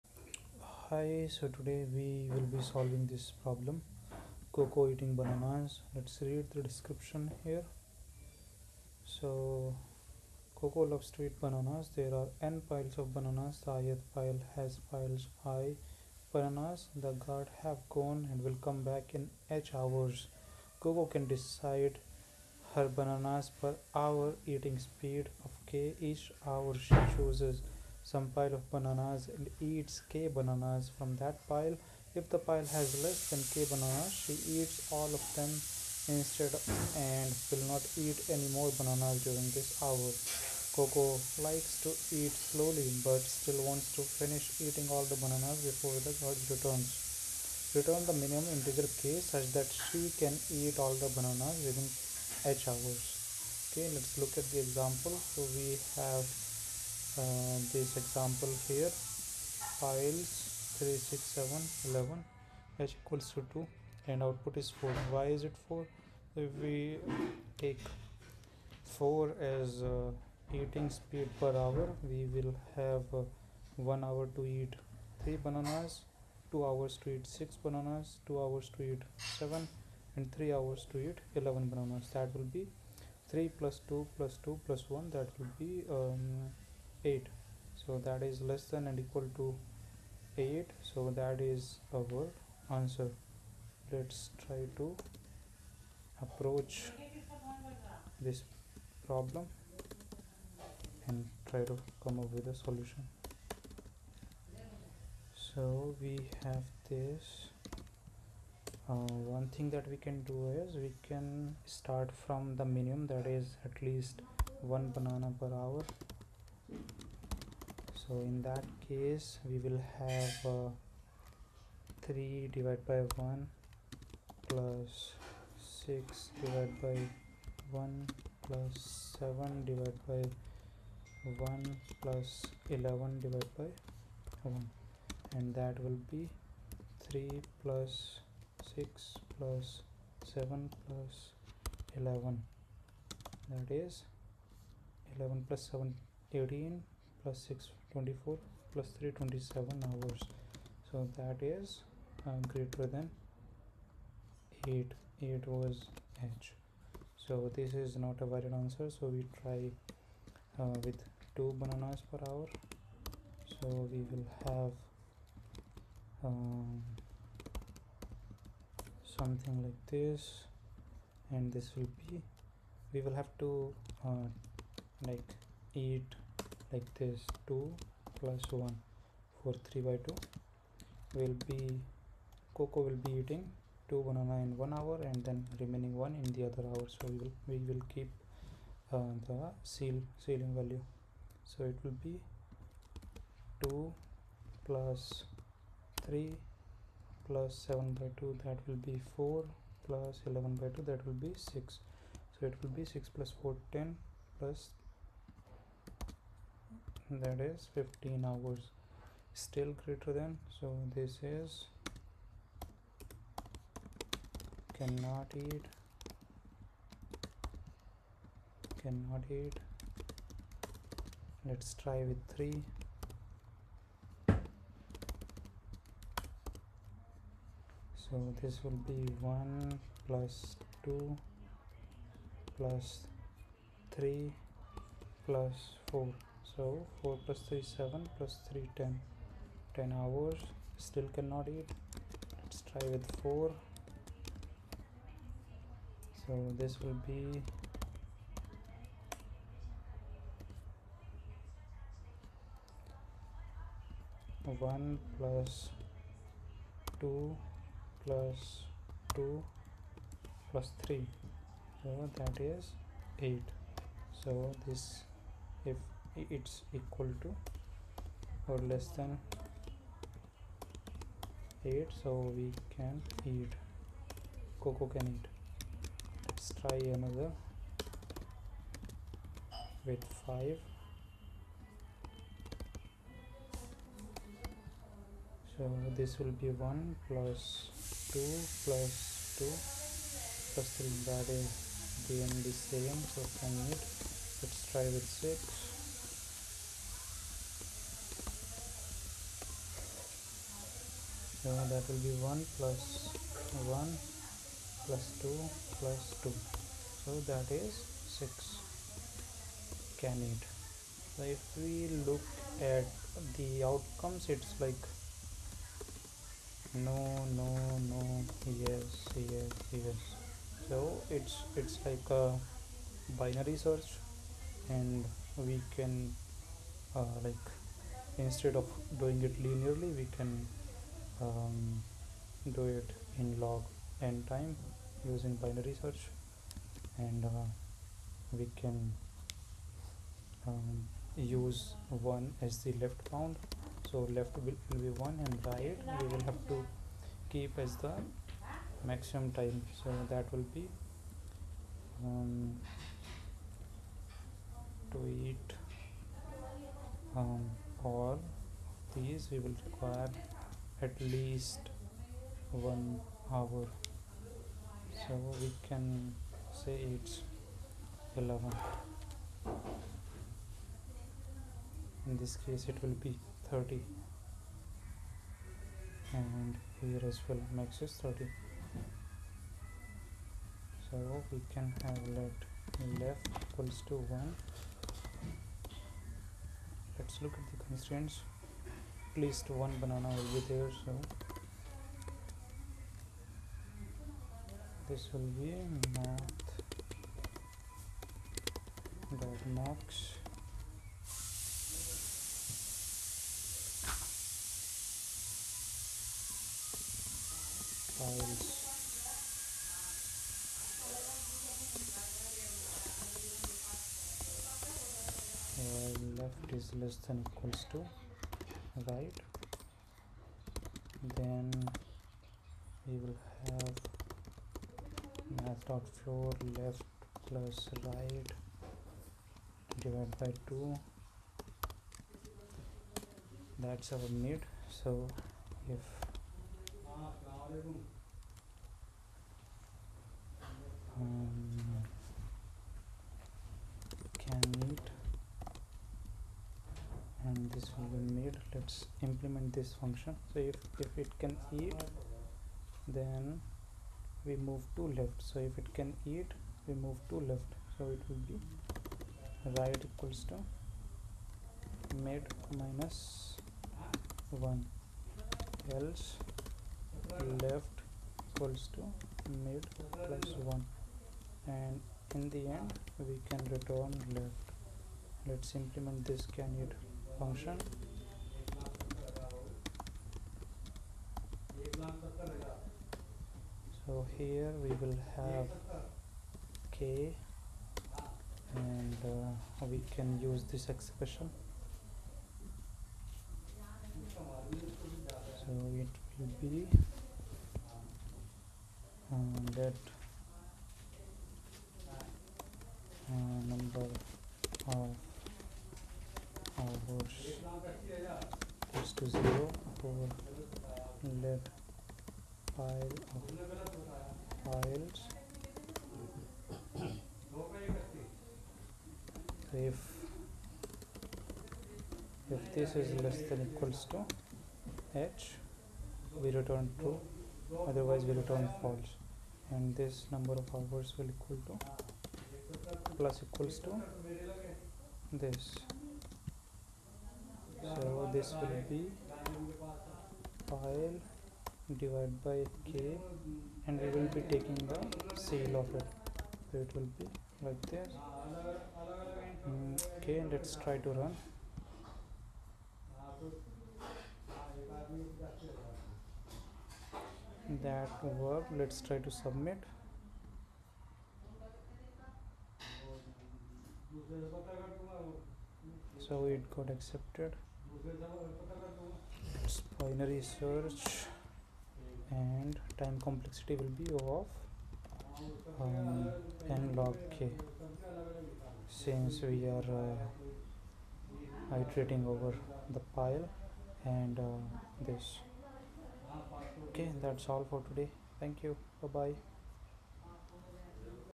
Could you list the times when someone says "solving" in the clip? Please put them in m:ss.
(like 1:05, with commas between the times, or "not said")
0:02.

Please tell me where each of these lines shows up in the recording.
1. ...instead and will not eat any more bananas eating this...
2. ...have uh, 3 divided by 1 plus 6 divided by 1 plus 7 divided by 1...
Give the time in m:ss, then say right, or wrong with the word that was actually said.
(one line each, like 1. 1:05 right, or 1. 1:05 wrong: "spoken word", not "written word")
1. 0:36 wrong: "during", not "eating"
2. 1:59 right.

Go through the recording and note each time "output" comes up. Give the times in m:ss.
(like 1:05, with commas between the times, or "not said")
1:04.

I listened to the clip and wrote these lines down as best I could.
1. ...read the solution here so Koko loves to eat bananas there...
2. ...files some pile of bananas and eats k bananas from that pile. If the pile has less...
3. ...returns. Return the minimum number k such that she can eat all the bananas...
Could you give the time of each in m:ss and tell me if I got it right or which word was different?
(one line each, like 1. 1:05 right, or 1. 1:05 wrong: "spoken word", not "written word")
1. 0:06 wrong: "description", not "solution"
2. 0:27 wrong: "chooses", not "files"
3. 0:46 wrong: "integer", not "number".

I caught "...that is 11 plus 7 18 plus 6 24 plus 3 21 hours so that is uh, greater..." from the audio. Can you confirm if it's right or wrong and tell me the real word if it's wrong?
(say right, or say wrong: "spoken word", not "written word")
wrong: "27", not "21".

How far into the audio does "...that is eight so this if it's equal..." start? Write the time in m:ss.
4:22.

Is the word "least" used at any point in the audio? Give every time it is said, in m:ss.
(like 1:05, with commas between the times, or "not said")
1:53, 6:01, 6:29.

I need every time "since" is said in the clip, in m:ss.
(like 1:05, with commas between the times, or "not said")
9:38.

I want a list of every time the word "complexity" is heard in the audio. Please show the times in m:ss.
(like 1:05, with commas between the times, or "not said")
9:33.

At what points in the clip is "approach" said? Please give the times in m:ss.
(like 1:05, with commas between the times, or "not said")
1:36.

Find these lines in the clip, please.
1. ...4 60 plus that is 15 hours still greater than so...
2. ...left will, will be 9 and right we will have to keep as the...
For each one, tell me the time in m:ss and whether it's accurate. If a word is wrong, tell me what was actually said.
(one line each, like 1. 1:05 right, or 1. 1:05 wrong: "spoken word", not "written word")
1. 3:23 wrong: "10", not "60"
2. 5:44 wrong: "1", not "9".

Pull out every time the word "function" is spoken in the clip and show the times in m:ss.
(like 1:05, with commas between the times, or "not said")
7:29, 7:57.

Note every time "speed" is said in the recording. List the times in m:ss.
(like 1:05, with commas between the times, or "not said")
0:24, 1:10.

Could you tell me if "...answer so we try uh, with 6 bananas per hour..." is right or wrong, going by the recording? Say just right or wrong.
wrong.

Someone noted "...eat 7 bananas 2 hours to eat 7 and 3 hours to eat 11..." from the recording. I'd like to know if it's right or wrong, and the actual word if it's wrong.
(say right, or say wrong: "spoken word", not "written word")
wrong: "6", not "7".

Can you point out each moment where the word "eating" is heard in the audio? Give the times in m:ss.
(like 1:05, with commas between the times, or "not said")
0:04, 0:24, 0:44, 1:10, 3:03.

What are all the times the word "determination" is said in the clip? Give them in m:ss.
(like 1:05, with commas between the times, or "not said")
not said.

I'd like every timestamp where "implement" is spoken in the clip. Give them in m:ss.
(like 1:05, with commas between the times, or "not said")
7:29, 7:55.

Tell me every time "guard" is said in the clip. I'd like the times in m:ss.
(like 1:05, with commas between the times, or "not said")
0:17.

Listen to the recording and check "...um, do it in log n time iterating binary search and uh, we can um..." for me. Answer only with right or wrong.
wrong.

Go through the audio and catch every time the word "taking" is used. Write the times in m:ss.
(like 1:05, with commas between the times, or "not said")
9:04.